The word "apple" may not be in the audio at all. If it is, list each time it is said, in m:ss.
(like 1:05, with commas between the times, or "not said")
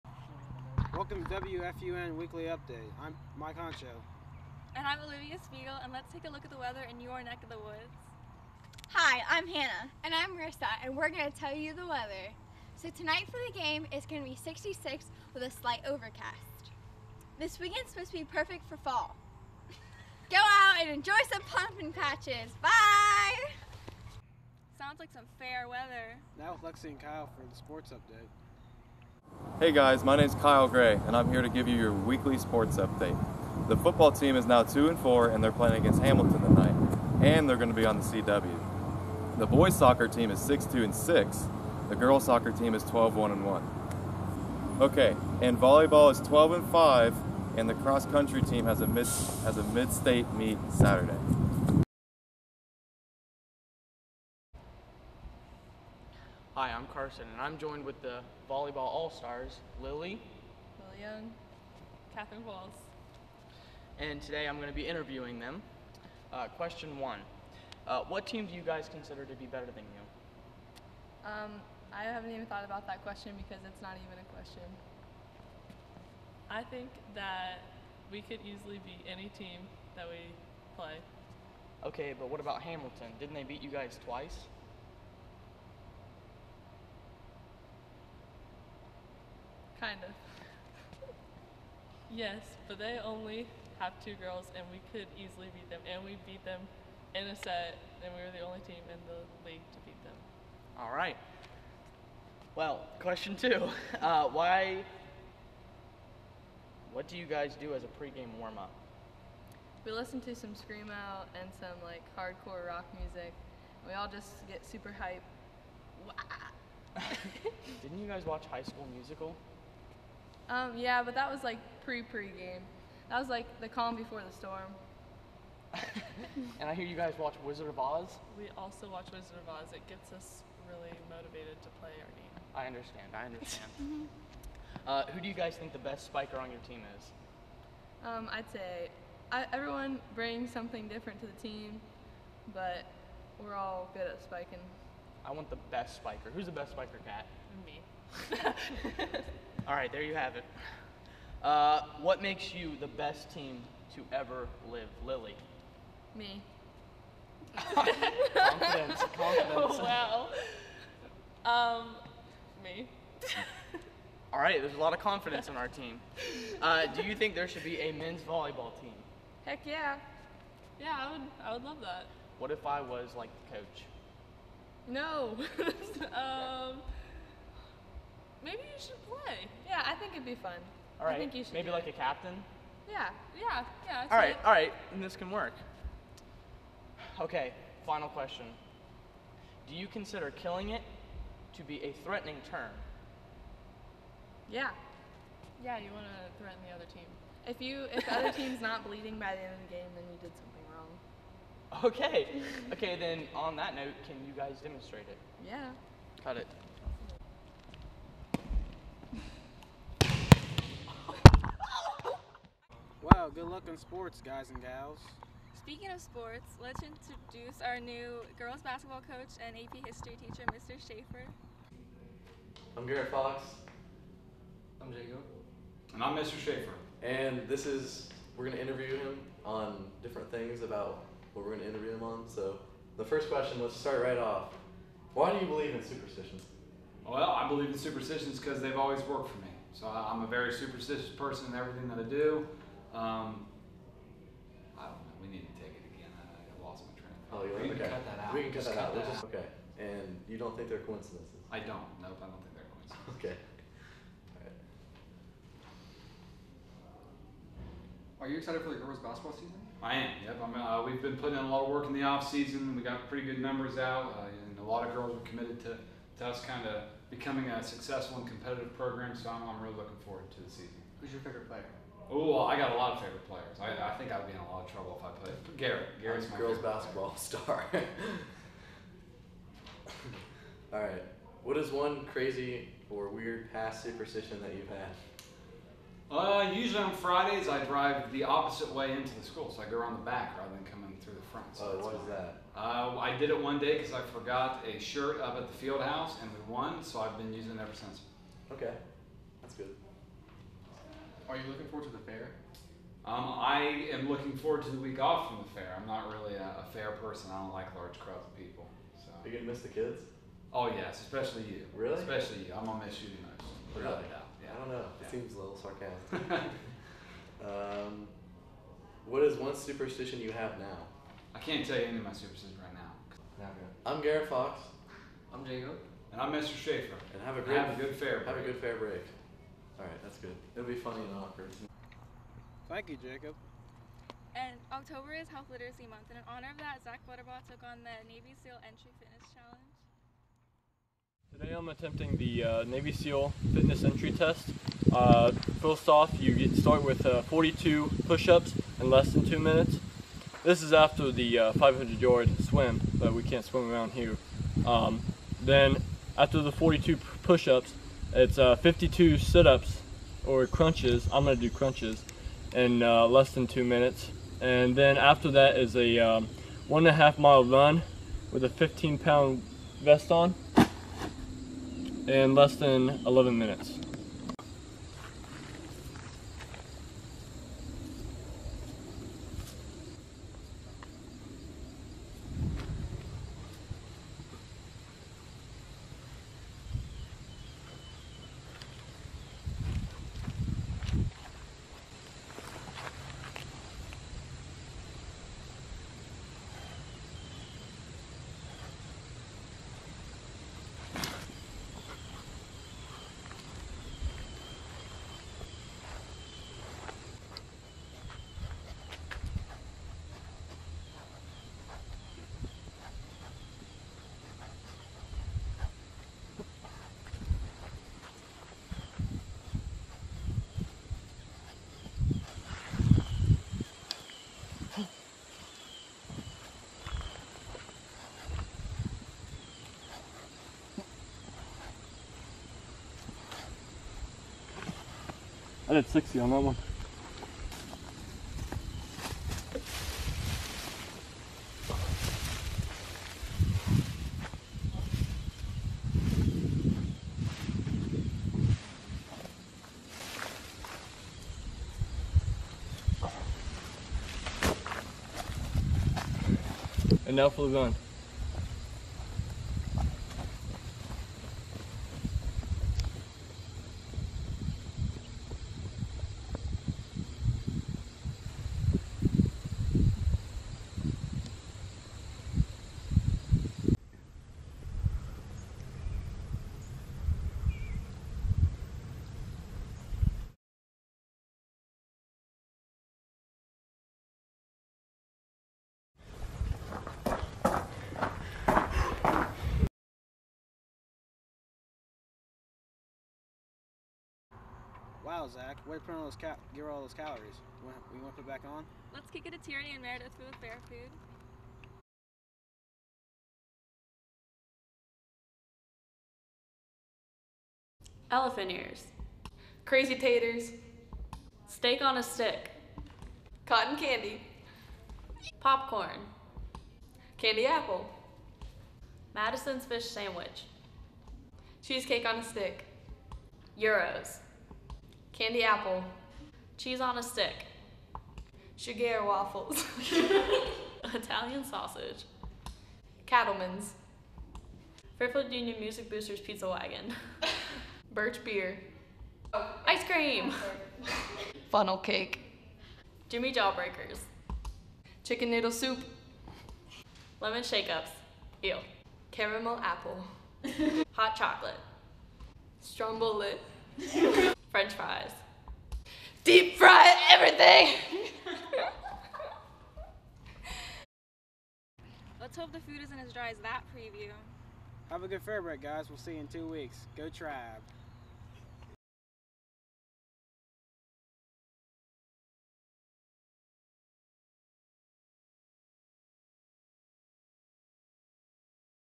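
8:37, 8:45, 9:09.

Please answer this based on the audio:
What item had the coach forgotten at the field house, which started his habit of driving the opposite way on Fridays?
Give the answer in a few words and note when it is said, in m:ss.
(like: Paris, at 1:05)
A shirt, at 4:54.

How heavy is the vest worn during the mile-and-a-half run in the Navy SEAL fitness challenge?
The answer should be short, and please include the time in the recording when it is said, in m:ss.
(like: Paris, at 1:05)
15 pounds, at 6:08.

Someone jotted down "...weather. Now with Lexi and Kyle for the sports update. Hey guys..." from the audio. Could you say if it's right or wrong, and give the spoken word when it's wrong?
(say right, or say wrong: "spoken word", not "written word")
right.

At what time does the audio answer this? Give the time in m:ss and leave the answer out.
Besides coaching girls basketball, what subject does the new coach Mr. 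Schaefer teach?
3:39.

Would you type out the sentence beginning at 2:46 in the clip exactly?
Uh, do you think there should be a men's volleyball team?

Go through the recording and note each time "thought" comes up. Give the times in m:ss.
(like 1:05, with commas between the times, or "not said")
1:12, 4:07.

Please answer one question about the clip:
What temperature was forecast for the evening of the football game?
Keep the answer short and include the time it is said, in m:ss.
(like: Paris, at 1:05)
66, at 0:14.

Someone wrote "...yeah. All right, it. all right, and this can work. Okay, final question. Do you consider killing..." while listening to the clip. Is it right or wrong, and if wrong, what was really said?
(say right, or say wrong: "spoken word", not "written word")
right.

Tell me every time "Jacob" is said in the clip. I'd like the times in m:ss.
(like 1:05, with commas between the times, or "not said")
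3:44, 5:25, 5:33.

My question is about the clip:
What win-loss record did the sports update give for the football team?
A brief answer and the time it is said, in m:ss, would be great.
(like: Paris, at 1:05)
2 and 4, at 0:34.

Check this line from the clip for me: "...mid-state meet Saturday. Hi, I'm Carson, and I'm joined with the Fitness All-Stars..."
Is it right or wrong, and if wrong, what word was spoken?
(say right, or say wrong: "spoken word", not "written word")
wrong: "Volleyball", not "Fitness".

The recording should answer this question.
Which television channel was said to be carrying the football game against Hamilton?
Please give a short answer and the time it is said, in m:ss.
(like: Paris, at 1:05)
CW, at 0:38.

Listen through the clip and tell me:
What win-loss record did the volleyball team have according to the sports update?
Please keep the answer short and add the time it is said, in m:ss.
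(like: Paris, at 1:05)
12 and 5, at 0:46.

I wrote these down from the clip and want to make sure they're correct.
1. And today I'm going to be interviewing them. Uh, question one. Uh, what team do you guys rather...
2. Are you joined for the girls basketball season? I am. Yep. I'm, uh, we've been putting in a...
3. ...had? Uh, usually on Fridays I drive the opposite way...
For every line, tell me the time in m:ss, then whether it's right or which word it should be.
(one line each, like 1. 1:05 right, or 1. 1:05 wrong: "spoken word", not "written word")
1. 1:03 wrong: "consider", not "rather"
2. 4:18 wrong: "excited", not "joined"
3. 4:44 right.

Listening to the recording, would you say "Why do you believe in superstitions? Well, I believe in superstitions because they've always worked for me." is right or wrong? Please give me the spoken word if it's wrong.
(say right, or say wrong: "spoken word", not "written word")
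right.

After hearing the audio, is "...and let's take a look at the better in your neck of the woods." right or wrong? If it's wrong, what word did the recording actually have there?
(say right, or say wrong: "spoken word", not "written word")
wrong: "weather", not "better".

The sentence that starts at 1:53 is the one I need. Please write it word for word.
We all just get super hype.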